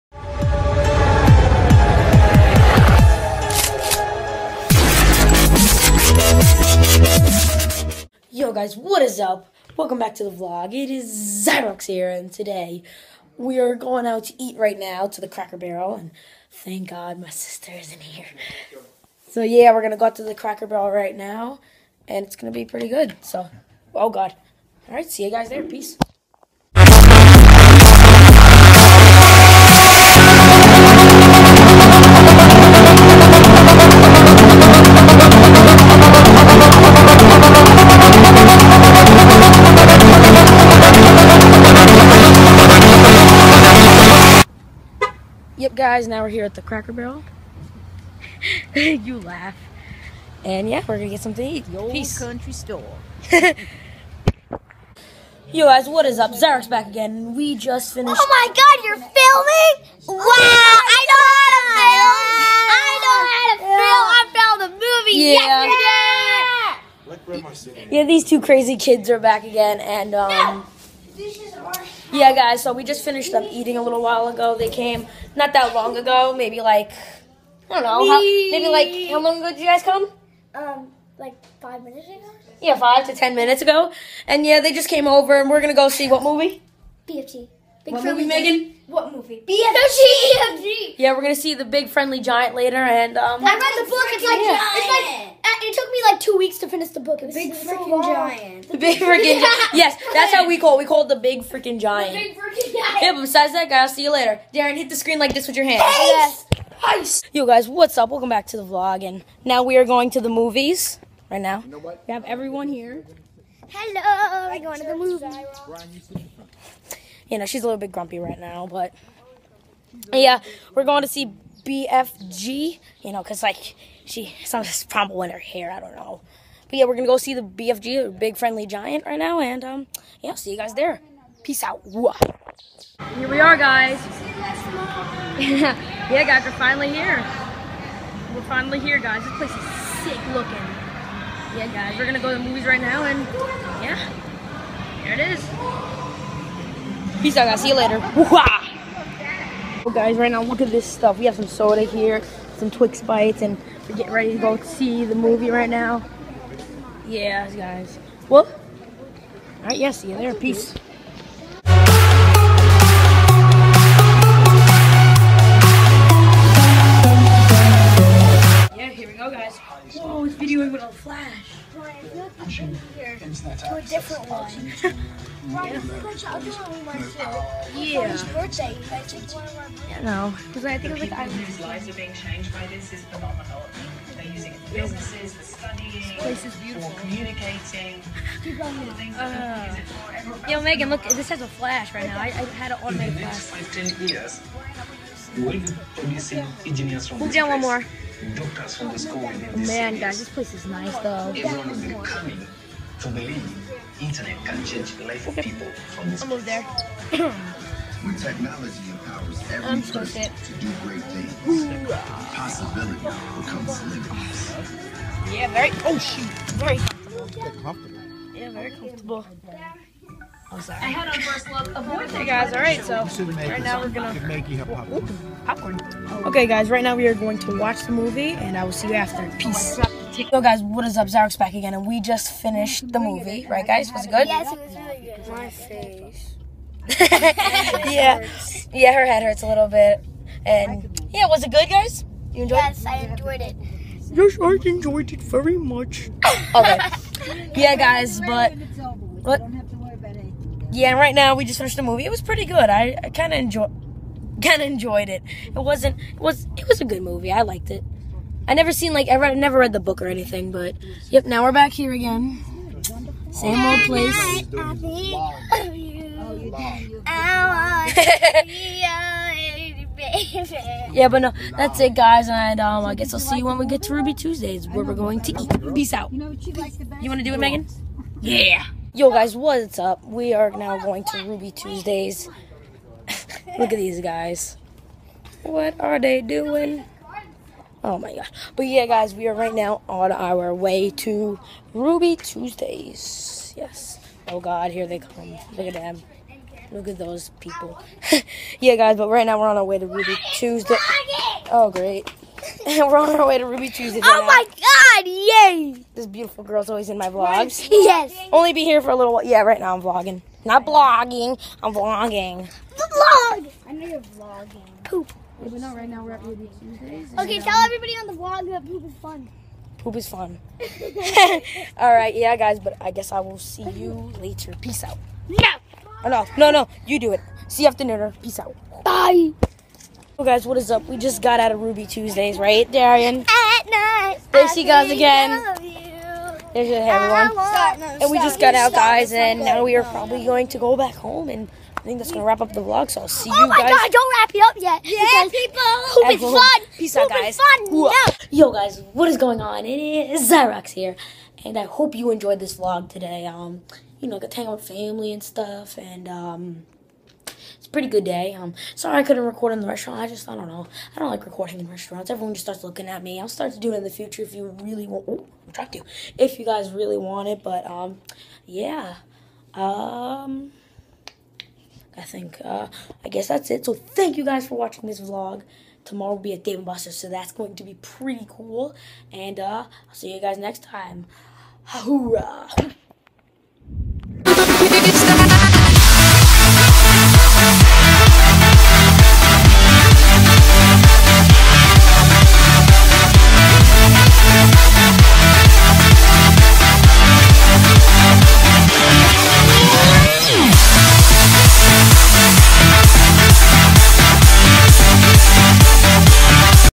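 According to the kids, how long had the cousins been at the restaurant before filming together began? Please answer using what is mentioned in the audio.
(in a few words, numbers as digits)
5 minutes.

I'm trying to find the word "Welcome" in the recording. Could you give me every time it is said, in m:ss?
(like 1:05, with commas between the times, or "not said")
0:09, 1:48.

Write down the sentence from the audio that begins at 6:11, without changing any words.
I think, uh, I guess that's it.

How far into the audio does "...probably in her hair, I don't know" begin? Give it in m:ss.
2:04.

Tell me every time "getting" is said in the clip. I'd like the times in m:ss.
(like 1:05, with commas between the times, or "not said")
2:33.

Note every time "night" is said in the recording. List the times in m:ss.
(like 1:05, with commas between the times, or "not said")
5:33.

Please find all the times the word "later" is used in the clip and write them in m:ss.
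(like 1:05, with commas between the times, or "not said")
1:32, 1:44, 2:27, 5:24.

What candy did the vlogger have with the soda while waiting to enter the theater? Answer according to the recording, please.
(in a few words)
Twix Bites.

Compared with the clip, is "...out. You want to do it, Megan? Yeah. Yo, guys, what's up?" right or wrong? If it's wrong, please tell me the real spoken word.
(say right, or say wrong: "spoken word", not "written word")
right.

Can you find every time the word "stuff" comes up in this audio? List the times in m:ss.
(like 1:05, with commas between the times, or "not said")
2:30, 5:55.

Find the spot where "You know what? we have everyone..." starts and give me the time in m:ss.
1:51.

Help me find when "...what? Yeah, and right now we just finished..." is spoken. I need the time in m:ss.
4:09.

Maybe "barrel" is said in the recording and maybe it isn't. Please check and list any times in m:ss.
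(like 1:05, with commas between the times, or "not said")
0:15, 0:20, 0:46.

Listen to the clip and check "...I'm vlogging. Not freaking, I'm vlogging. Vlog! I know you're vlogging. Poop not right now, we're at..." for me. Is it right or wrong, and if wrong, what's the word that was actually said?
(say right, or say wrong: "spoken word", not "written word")
wrong: "blogging", not "freaking".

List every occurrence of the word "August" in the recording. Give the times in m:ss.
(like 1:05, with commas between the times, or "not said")
not said.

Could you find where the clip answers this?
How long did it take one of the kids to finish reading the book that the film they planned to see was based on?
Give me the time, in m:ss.
1:36.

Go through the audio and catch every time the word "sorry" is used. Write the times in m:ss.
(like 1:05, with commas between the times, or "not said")
3:40, 5:58.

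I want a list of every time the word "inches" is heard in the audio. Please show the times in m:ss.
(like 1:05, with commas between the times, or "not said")
not said.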